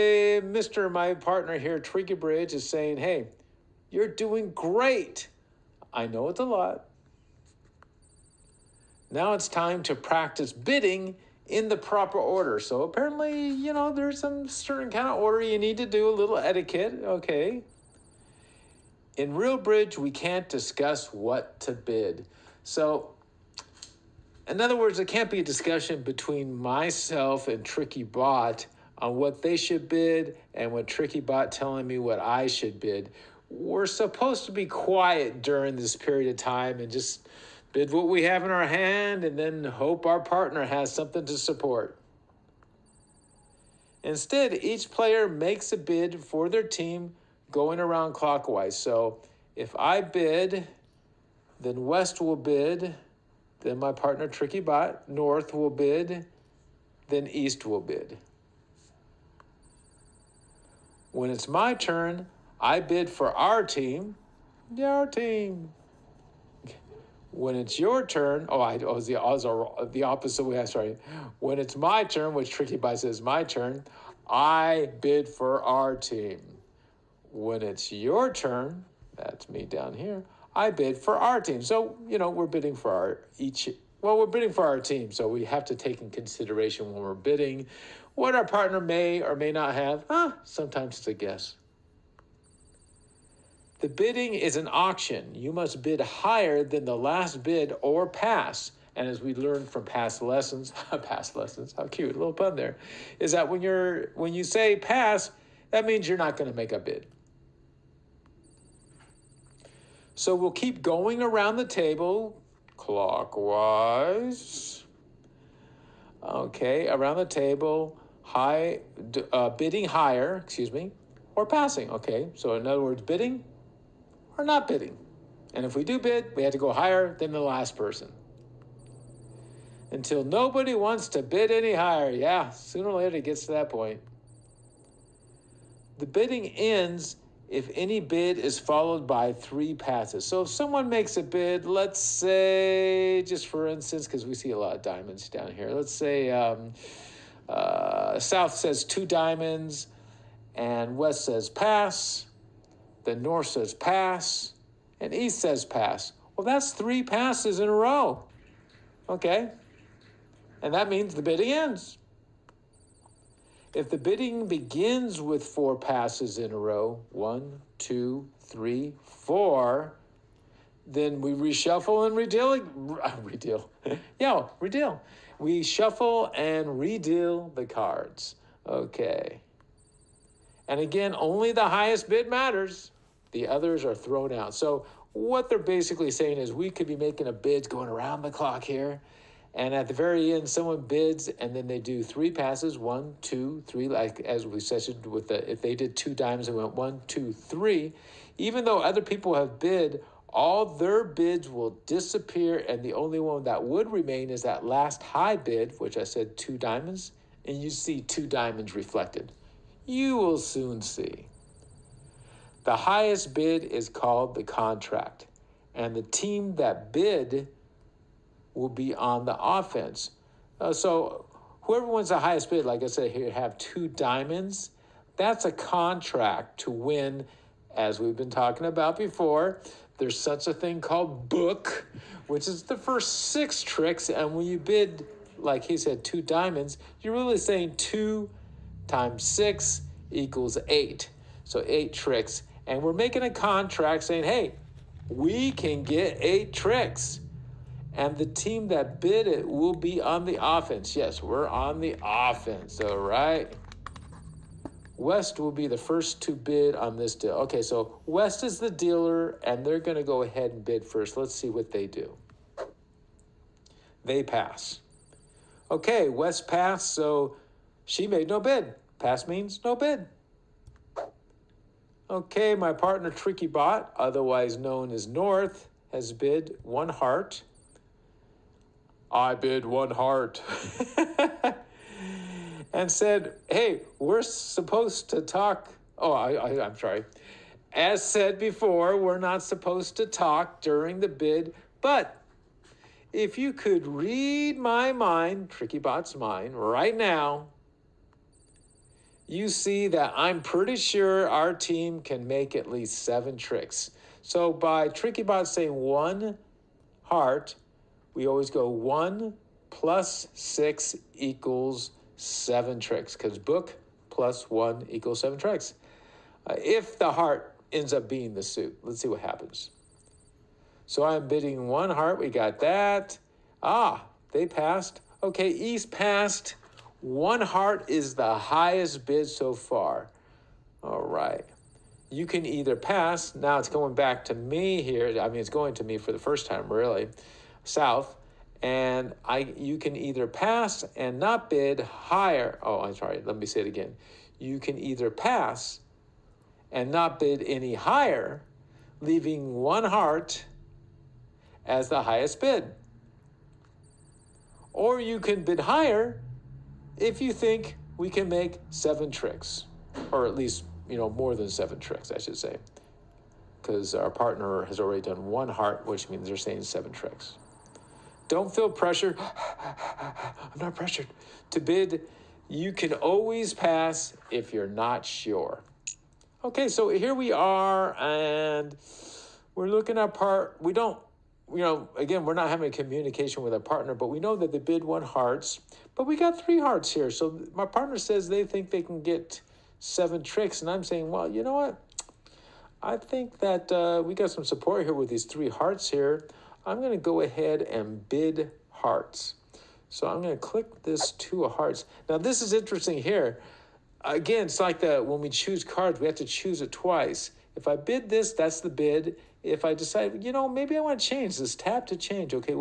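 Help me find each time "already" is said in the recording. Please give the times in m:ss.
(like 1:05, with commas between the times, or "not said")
6:04.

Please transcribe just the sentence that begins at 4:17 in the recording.
Okay, so West is the dealer, and they're going to go ahead and bid first.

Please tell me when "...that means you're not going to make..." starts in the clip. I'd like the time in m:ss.
1:45.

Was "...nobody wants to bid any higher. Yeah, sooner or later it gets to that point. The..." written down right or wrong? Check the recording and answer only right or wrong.
right.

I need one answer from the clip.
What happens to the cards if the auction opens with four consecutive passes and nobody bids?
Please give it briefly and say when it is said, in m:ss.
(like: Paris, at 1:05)
reshuffle and redeal, at 2:51.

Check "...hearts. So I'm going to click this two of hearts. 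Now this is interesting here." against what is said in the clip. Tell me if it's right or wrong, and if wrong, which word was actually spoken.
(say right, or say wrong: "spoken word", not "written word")
right.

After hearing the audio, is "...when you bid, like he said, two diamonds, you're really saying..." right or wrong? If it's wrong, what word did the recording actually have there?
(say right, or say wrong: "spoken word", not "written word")
right.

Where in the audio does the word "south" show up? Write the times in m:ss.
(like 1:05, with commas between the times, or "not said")
2:28, 5:37.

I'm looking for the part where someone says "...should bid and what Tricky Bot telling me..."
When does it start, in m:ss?
0:29.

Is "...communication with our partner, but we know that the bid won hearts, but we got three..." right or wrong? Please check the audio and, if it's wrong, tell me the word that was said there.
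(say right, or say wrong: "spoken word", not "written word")
right.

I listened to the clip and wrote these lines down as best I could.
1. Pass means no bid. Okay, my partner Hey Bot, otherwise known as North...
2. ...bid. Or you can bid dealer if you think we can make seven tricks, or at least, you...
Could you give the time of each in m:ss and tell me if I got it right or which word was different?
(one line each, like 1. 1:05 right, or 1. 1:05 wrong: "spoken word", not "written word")
1. 4:28 wrong: "Tricky", not "Hey"
2. 5:52 wrong: "higher", not "dealer".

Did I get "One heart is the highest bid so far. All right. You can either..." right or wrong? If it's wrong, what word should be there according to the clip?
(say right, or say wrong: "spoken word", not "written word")
right.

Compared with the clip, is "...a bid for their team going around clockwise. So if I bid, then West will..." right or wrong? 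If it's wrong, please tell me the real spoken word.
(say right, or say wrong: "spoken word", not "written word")
right.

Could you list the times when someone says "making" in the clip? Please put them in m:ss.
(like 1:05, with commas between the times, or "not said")
3:06, 4:02.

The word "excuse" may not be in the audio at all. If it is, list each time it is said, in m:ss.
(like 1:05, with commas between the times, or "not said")
2:00.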